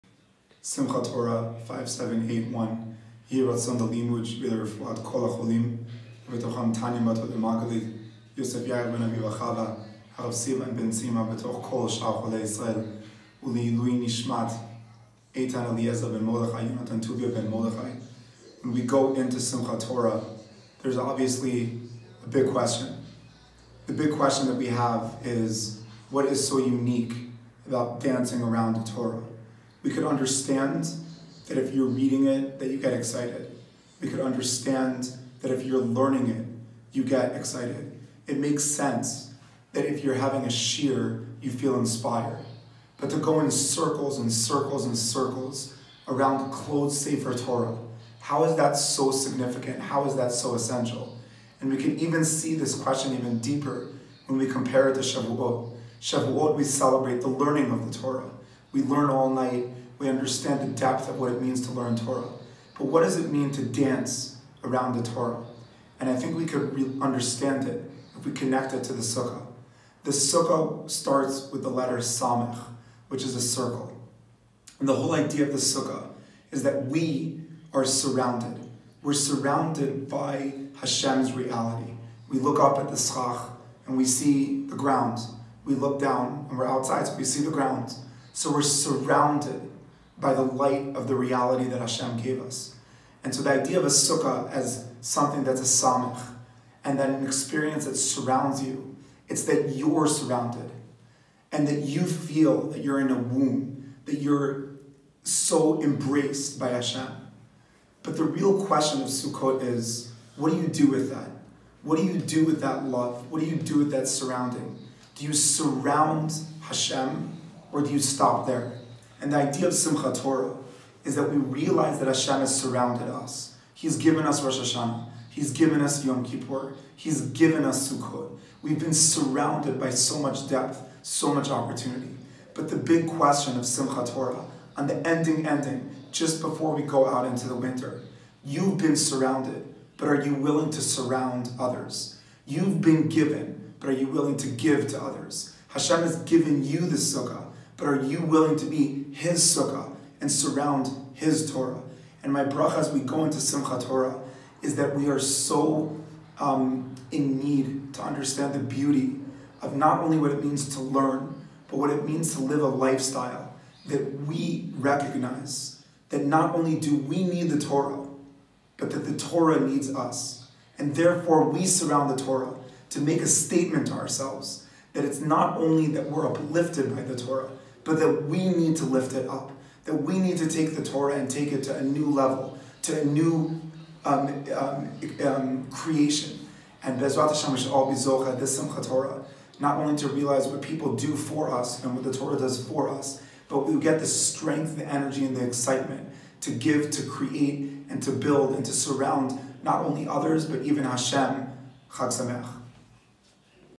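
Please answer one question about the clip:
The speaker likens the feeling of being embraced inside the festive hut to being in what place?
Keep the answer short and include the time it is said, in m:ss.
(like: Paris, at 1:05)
A womb, at 1:43.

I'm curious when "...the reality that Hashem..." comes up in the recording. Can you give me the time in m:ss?
1:31.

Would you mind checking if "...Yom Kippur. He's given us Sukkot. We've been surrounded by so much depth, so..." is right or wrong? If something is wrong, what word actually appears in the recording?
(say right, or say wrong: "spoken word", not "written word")
right.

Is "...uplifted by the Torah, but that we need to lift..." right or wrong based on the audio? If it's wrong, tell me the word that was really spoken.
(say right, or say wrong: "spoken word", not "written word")
right.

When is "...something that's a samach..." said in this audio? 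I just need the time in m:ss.
1:35.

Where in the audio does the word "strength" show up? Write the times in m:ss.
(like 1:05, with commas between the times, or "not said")
3:14.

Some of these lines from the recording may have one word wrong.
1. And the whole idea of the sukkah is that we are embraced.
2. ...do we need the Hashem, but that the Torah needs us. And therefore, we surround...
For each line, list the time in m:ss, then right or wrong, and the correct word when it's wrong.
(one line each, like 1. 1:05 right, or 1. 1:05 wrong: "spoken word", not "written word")
1. 1:14 wrong: "surrounded", not "embraced"
2. 2:46 wrong: "Torah", not "Hashem".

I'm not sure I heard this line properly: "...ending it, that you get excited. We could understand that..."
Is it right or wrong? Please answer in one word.
wrong.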